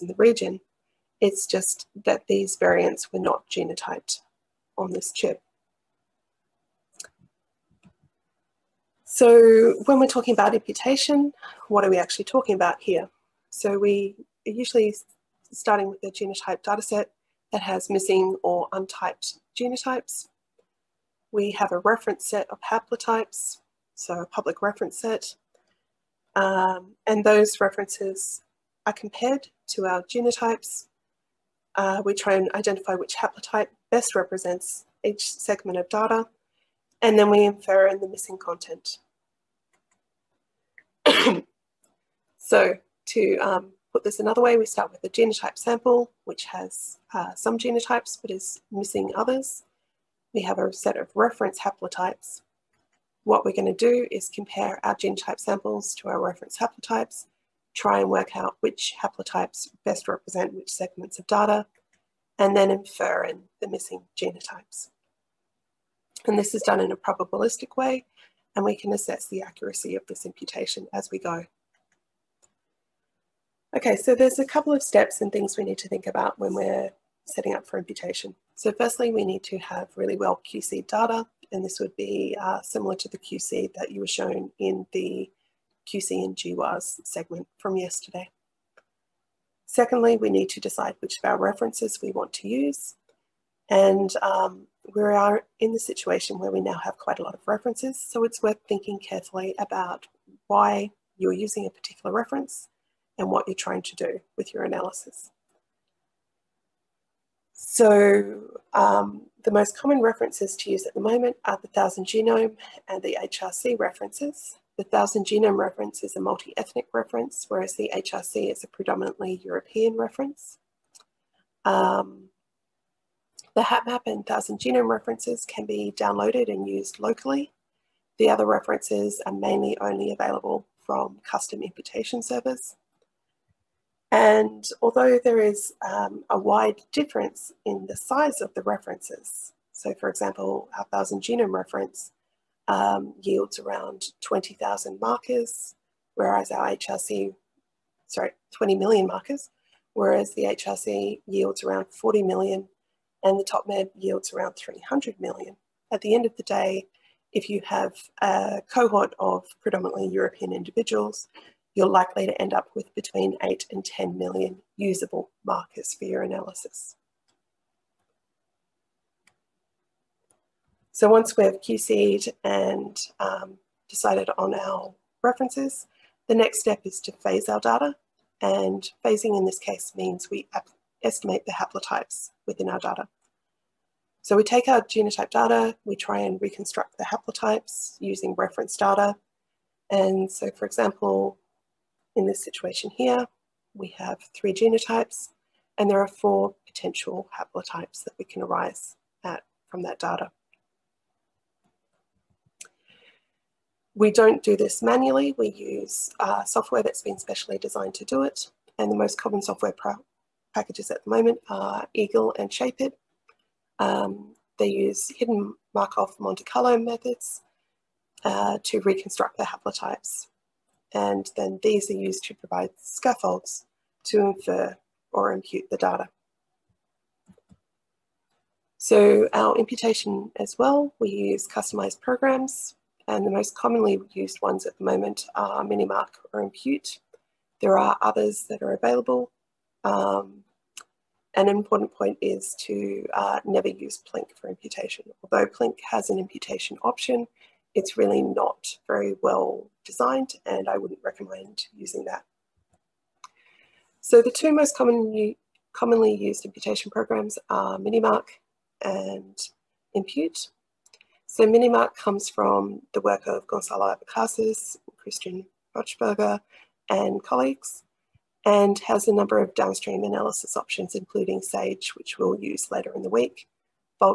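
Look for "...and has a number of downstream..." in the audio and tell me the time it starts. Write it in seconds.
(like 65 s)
268 s.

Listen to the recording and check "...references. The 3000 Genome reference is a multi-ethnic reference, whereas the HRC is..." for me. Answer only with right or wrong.
wrong.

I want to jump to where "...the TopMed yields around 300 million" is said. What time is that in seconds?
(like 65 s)
153 s.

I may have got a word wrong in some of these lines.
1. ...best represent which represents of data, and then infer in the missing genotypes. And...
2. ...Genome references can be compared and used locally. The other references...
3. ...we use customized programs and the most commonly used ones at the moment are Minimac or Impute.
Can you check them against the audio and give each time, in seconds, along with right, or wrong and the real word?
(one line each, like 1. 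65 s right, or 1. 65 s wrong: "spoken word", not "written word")
1. 59 s wrong: "segments", not "represents"
2. 124 s wrong: "downloaded", not "compared"
3. 230 s right.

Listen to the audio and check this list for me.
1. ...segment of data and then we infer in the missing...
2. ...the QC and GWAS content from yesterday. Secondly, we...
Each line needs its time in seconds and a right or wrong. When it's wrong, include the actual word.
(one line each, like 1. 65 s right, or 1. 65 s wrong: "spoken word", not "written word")
1. 35 s right
2. 84 s wrong: "segment", not "content".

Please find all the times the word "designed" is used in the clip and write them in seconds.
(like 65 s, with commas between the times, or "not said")
207 s, 249 s.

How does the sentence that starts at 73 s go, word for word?
Okay, so there's a couple of steps and things we need to think about when we're setting up for imputation.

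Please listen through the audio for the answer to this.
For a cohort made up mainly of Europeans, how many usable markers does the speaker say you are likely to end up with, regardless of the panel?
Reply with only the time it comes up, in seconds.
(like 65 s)
162 s.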